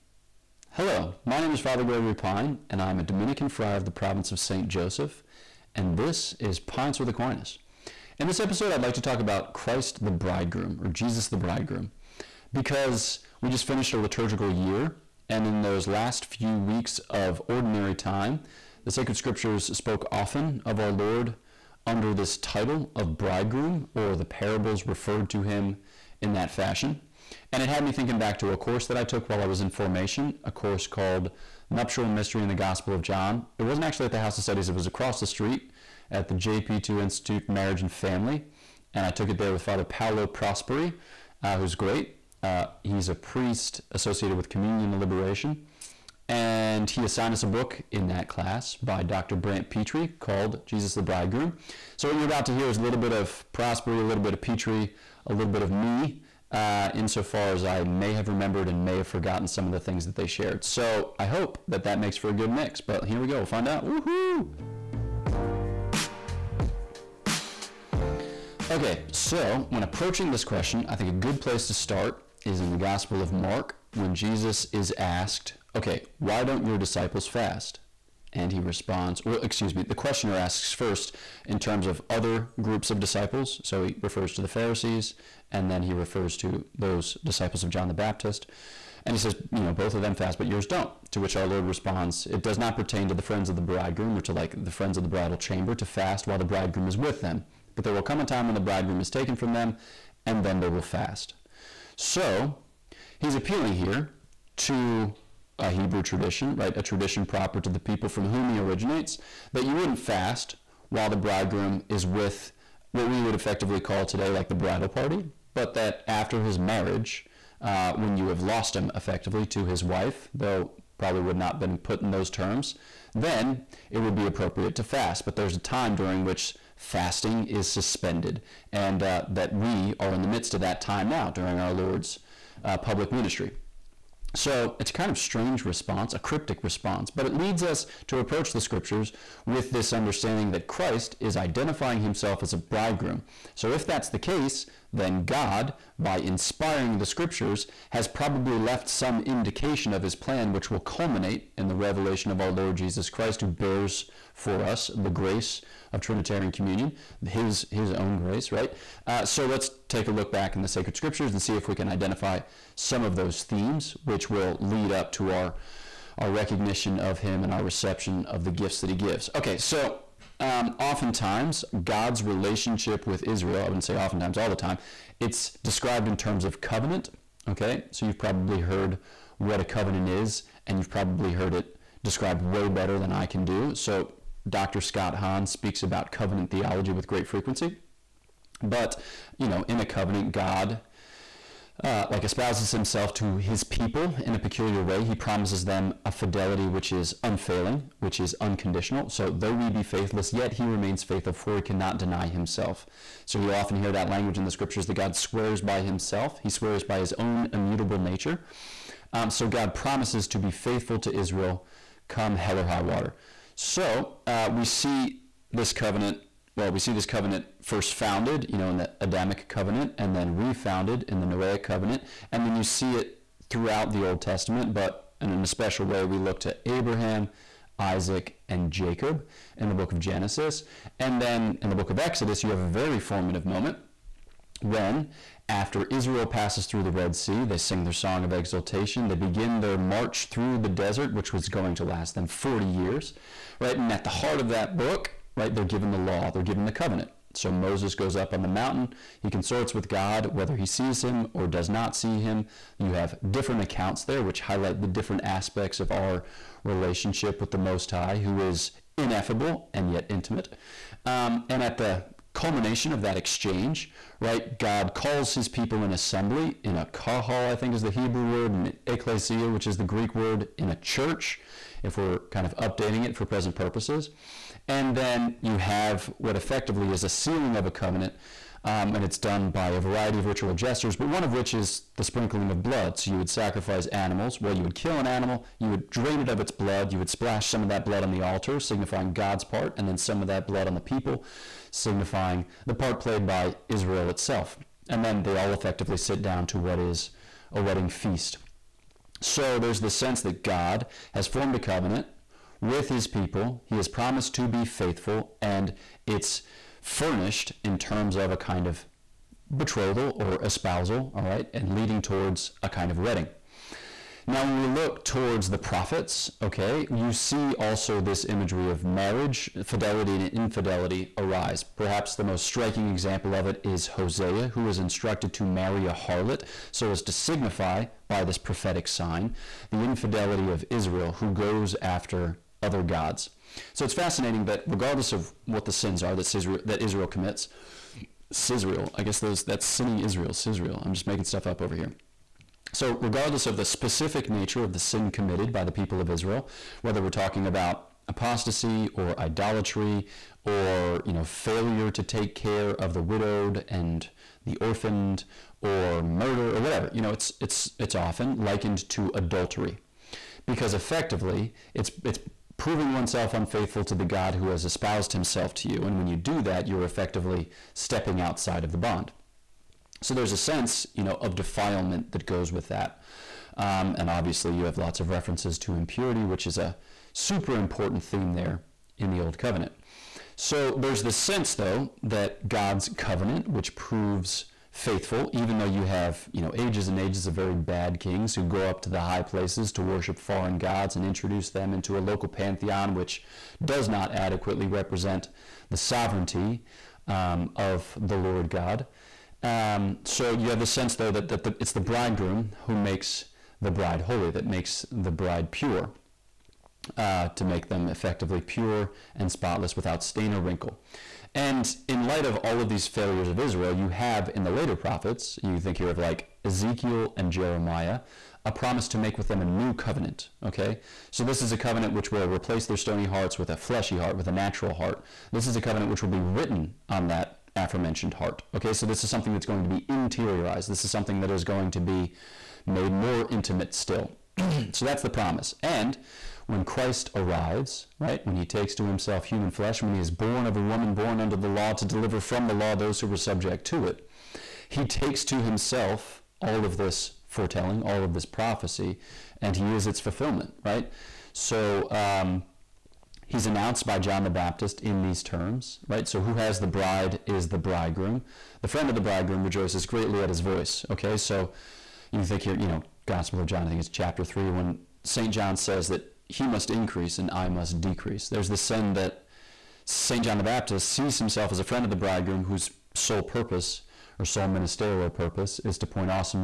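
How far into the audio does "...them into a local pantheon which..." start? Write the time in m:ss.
6:31.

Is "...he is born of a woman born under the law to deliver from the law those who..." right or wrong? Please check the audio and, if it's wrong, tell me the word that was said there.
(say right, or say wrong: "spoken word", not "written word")
right.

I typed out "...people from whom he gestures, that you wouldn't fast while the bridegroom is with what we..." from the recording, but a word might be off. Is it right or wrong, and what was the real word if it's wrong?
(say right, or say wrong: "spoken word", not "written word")
wrong: "originates", not "gestures".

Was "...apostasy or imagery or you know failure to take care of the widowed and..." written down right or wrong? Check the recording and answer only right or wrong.
wrong.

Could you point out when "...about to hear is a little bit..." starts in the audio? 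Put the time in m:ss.
0:52.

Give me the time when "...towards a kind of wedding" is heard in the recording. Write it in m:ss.
5:12.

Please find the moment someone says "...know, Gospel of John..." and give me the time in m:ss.
7:42.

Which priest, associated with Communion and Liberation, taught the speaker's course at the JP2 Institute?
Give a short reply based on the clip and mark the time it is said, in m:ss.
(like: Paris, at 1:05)
Father Paolo Prosperi, at 0:39.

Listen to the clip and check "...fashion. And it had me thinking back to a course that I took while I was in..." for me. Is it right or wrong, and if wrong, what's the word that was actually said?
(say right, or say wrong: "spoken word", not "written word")
right.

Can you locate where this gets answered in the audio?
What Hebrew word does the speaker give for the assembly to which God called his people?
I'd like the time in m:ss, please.
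4:26.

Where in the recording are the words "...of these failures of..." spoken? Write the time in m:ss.
6:52.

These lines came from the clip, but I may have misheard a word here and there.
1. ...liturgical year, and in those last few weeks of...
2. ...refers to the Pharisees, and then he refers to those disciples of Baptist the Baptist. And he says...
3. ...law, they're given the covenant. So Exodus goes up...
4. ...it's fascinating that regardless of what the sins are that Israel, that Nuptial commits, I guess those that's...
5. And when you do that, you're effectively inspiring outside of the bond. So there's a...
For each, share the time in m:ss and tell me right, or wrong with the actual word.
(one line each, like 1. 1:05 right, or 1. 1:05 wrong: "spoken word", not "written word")
1. 0:13 right
2. 1:24 wrong: "John", not "Baptist"
3. 4:05 wrong: "Moses", not "Exodus"
4. 5:33 wrong: "Israel", not "Nuptial"
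5. 6:05 wrong: "stepping", not "inspiring".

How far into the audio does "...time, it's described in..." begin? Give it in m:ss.
2:54.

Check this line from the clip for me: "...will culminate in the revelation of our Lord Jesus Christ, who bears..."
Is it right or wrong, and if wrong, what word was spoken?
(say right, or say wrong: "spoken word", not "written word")
right.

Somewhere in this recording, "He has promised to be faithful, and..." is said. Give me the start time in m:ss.
5:03.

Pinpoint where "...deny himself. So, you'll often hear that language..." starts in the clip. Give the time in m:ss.
3:21.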